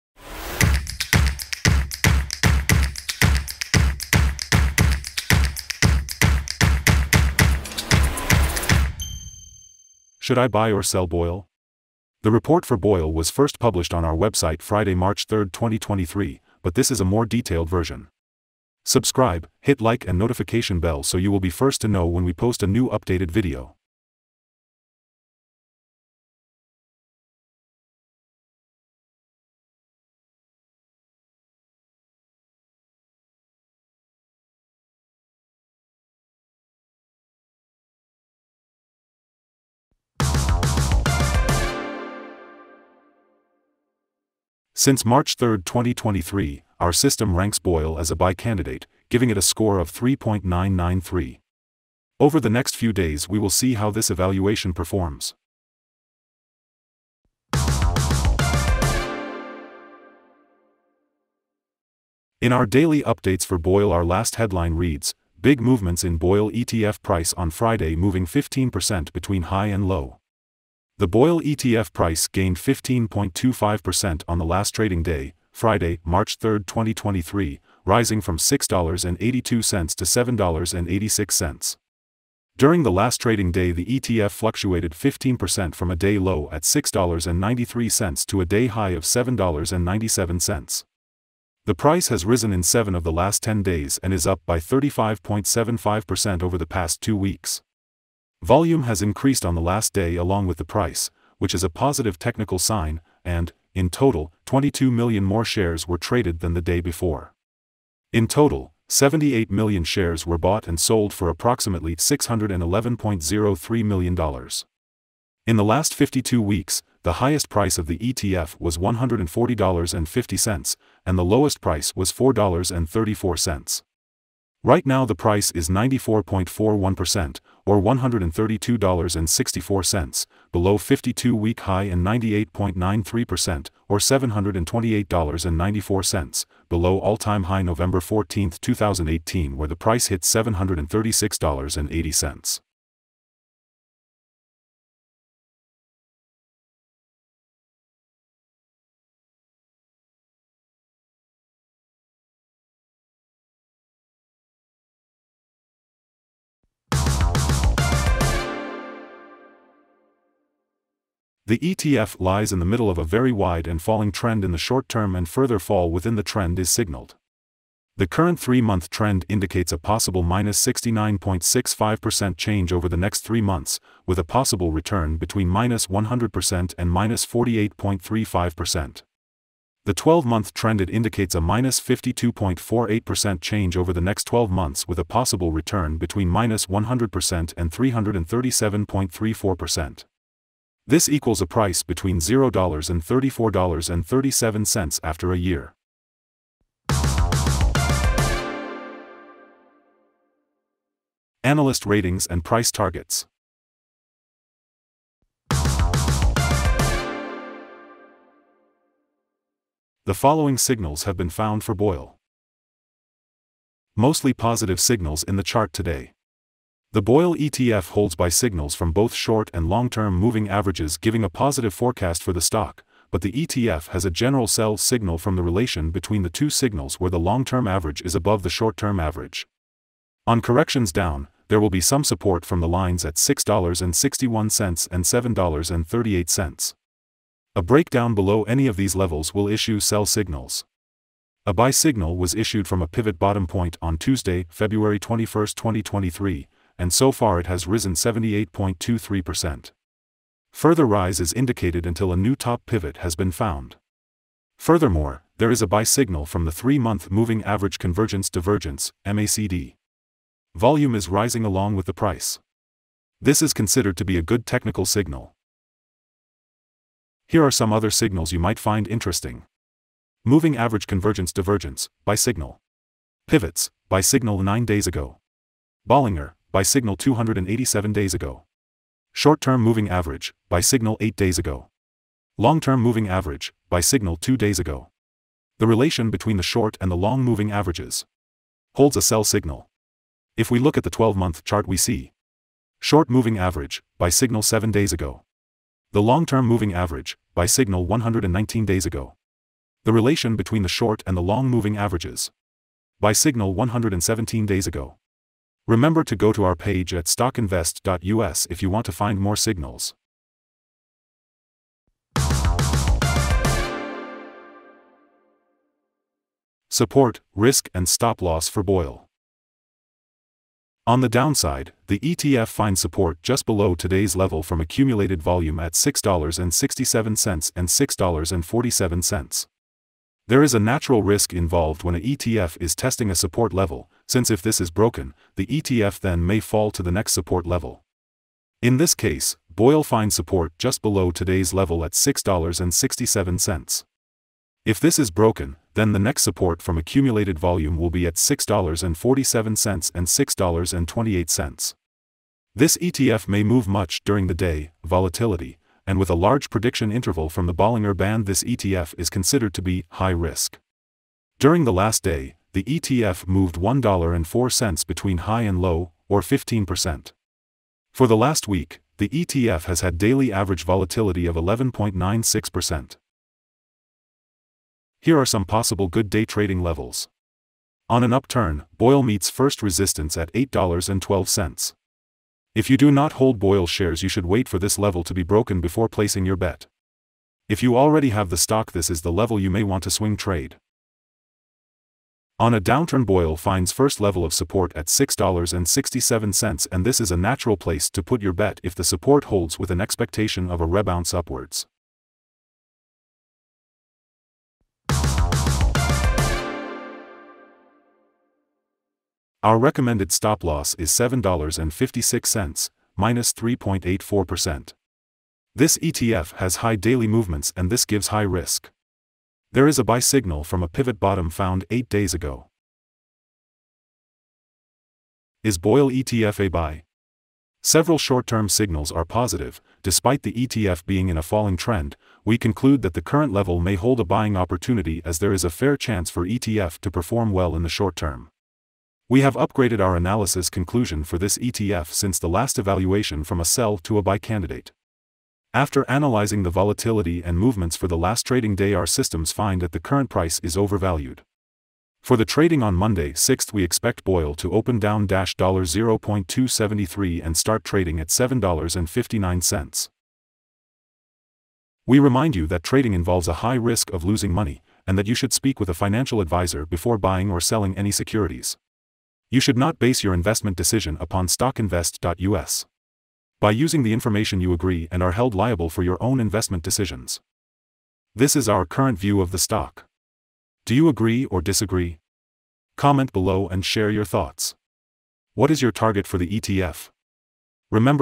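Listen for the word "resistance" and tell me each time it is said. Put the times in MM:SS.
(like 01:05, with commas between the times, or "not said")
06:19.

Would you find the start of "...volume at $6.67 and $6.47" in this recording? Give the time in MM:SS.
05:25.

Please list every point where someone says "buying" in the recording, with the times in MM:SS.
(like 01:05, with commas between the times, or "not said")
07:14, 07:46.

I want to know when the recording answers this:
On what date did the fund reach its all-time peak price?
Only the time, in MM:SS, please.
02:17.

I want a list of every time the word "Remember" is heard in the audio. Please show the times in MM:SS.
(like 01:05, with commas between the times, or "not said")
05:05, 08:07.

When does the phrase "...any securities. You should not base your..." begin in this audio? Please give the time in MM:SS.
07:47.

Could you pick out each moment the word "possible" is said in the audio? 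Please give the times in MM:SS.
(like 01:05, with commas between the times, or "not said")
02:49, 02:54, 03:05, 06:15.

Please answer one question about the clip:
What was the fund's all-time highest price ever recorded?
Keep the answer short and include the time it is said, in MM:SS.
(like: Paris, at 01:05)
$736.80, at 02:20.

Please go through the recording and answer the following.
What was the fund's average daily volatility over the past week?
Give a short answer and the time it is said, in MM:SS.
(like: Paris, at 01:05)
11.96%, at 06:11.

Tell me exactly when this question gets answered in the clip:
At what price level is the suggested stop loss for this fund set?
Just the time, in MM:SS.
06:50.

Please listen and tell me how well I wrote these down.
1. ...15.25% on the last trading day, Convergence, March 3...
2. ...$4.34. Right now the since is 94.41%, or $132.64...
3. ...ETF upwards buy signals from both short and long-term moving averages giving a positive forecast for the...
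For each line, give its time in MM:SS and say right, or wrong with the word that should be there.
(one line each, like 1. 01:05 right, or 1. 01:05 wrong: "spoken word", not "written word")
1. 01:12 wrong: "Friday", not "Convergence"
2. 02:02 wrong: "price", not "since"
3. 03:37 wrong: "holds", not "upwards".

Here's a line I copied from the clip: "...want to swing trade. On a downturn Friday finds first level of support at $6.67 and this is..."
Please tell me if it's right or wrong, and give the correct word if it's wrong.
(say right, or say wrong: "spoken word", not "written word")
wrong: "BOIL", not "Friday".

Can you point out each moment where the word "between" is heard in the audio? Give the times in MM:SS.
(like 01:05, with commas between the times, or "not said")
01:09, 02:55, 03:05, 03:11, 03:45, 04:46, 05:00, 06:04.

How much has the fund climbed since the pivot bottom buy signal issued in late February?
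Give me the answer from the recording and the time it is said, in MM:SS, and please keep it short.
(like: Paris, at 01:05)
78.23%, at 04:07.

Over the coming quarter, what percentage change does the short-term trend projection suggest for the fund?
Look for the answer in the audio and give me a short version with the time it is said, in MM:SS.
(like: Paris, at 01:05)
-69.65%, at 02:50.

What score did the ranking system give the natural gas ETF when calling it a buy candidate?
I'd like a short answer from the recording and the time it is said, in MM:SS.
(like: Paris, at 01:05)
3.993, at 00:49.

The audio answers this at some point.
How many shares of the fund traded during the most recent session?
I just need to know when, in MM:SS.
01:48.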